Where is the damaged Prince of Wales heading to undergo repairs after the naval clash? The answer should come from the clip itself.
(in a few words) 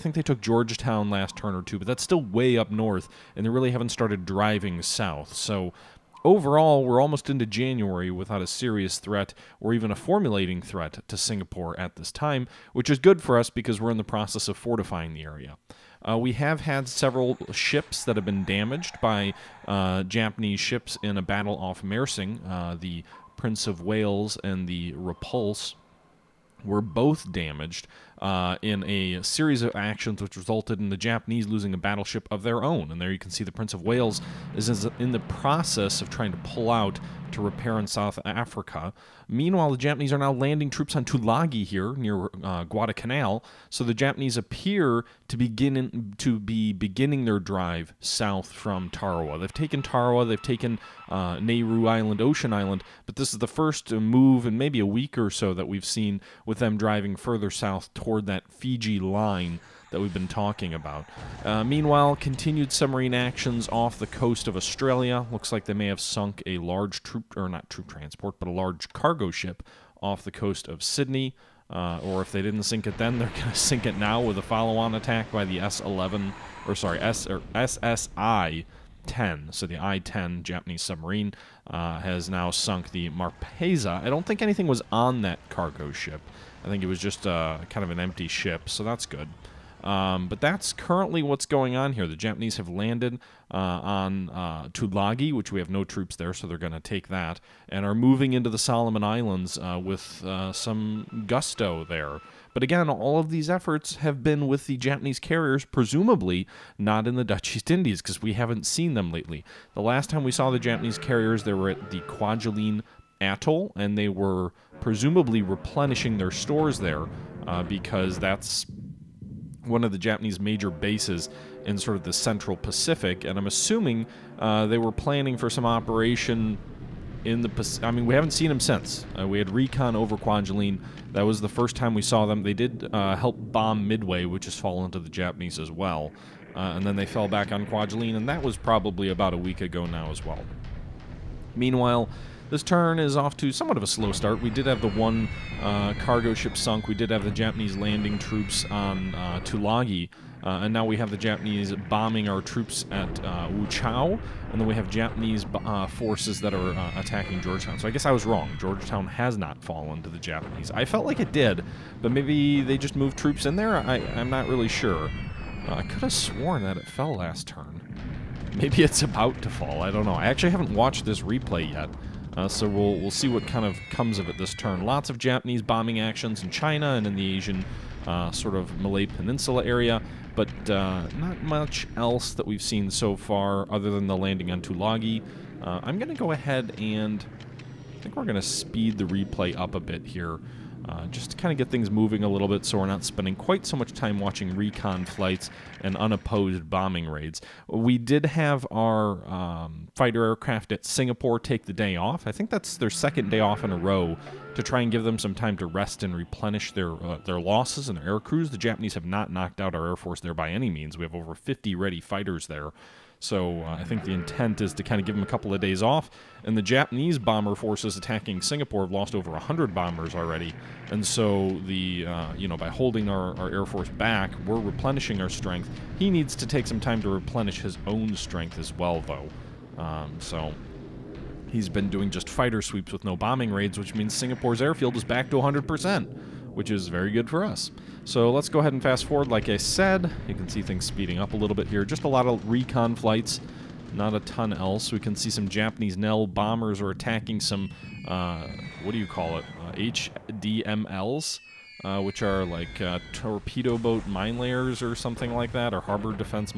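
South Africa.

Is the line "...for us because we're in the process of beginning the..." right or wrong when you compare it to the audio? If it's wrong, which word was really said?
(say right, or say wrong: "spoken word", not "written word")
wrong: "fortifying", not "beginning".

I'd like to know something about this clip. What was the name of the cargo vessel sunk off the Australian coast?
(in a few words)
Marpesa.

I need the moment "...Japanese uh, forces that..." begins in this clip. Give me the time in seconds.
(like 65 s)
154 s.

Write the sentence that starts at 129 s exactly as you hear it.
Uh, we had recon over Kwajalein.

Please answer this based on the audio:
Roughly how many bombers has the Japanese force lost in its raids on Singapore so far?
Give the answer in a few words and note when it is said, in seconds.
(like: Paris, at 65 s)
over 100, at 219 s.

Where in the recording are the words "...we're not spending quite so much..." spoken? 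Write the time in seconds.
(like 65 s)
192 s.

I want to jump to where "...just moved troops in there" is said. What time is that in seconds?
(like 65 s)
162 s.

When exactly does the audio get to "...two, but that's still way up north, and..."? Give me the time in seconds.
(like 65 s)
1 s.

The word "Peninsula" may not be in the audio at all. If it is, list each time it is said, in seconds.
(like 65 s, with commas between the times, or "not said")
179 s.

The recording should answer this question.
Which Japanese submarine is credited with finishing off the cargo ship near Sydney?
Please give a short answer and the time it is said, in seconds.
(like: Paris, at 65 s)
I-10, at 79 s.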